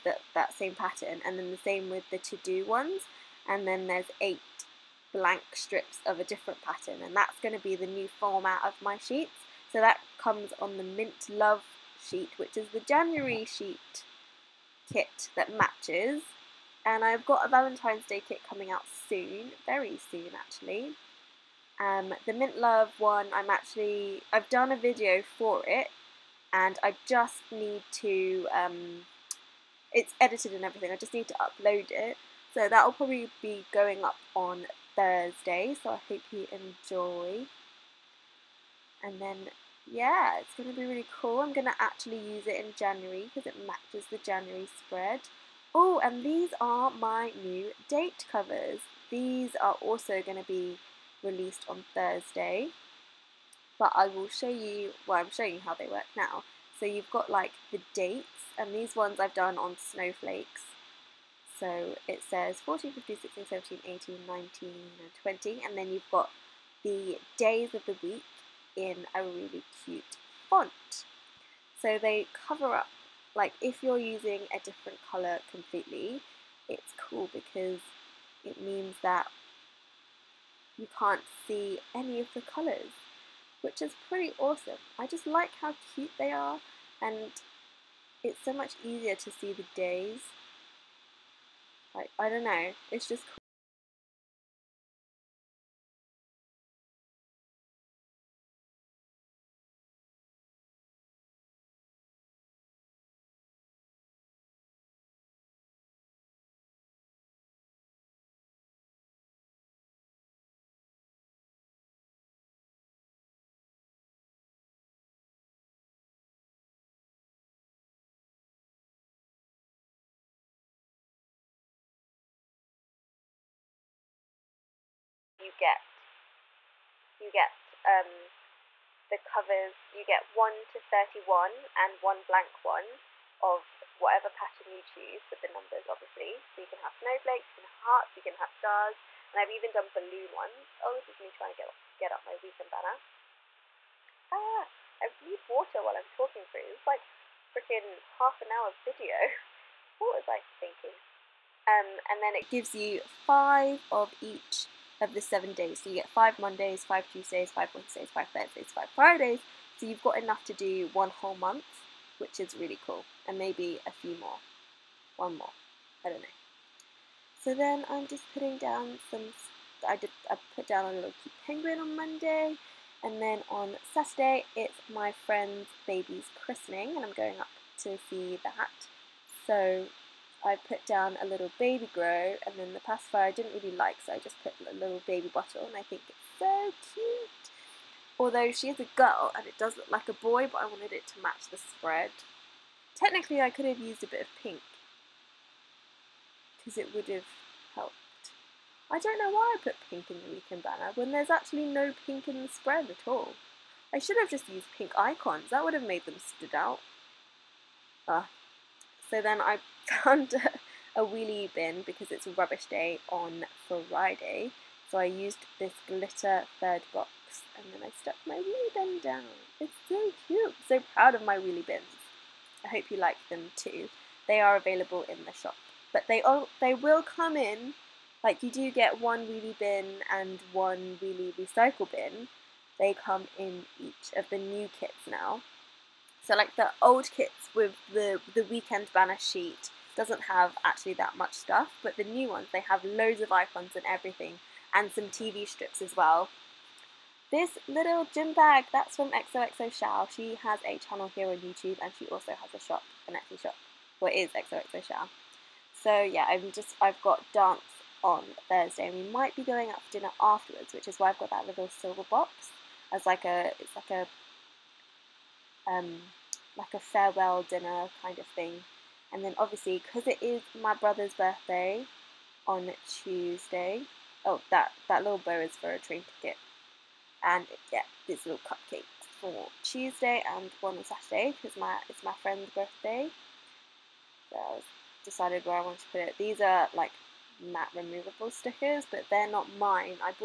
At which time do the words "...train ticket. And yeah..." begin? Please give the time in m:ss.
4:35.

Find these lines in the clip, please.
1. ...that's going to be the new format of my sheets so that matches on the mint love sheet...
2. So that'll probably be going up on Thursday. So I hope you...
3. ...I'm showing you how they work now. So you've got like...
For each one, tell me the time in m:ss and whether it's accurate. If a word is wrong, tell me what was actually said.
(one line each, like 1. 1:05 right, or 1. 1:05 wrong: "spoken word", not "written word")
1. 0:07 wrong: "comes", not "matches"
2. 0:32 right
3. 0:55 right.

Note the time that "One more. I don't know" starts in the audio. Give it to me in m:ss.
2:45.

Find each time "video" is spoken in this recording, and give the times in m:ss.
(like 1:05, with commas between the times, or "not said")
0:24, 2:28.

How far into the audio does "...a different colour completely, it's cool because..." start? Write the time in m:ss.
1:14.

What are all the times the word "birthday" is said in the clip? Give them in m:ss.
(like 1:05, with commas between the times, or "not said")
4:31, 4:42.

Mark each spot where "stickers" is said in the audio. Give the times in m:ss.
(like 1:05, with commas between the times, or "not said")
4:48.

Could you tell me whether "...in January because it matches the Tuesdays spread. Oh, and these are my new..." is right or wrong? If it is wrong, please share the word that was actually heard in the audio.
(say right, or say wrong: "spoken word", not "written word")
wrong: "January", not "Tuesdays".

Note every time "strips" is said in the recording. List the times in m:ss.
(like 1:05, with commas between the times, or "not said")
0:05, 4:05.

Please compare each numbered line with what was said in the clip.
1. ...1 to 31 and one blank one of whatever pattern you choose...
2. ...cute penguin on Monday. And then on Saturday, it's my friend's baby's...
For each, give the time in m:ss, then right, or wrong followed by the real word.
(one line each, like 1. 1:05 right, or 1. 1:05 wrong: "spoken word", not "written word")
1. 2:10 right
2. 2:51 right.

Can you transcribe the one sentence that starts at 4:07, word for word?
This little gym bag that's from xoxoxao.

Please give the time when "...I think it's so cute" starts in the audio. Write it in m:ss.
3:05.